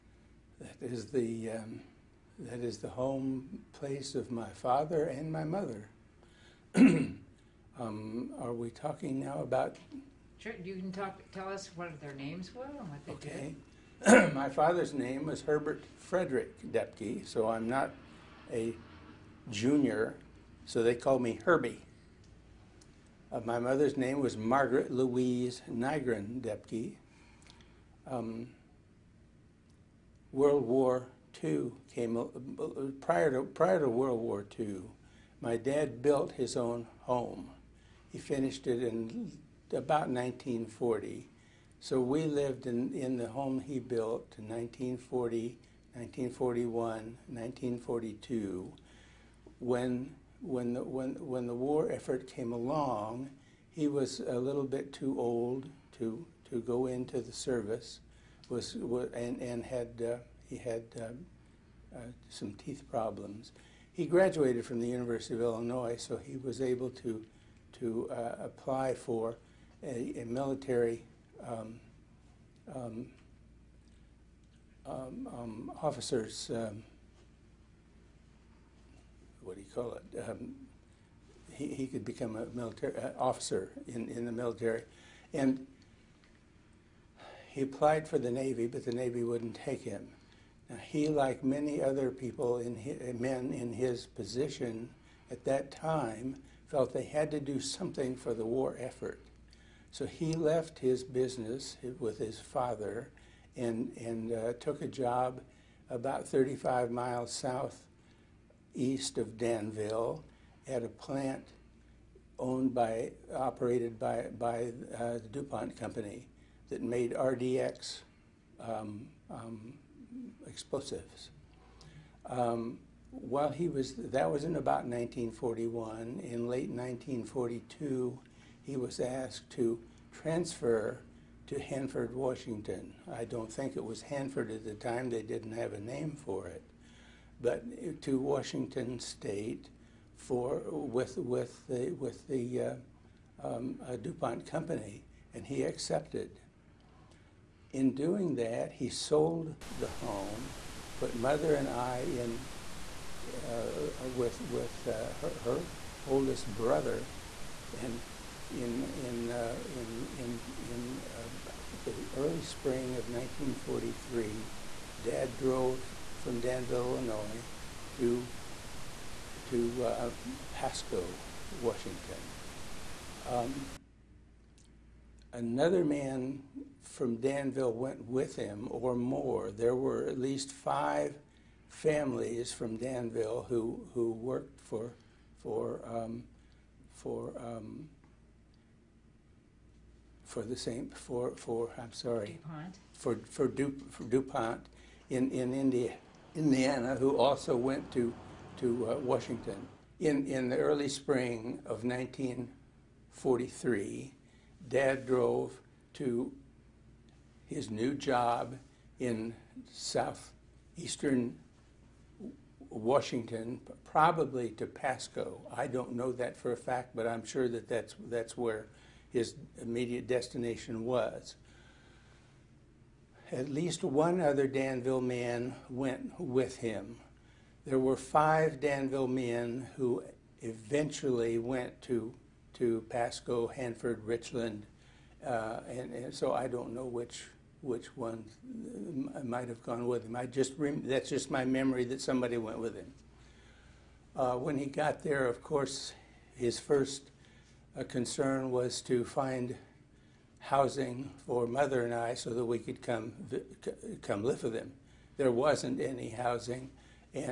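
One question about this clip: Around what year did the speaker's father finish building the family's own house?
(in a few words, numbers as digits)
1940.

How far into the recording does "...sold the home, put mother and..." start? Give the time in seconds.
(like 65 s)
148 s.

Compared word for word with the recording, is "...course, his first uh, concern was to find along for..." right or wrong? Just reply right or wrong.
wrong.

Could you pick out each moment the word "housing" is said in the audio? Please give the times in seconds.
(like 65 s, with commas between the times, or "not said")
250 s, 256 s.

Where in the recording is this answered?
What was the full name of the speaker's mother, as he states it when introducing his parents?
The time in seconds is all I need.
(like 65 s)
24 s.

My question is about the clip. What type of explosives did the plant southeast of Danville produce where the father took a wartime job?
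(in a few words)
RDX.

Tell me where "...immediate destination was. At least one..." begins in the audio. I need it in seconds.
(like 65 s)
219 s.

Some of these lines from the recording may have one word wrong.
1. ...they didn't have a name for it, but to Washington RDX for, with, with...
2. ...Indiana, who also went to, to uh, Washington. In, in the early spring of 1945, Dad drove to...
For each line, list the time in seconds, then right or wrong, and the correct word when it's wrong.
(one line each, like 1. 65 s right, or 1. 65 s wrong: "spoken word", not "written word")
1. 135 s wrong: "State", not "RDX"
2. 196 s wrong: "1943", not "1945".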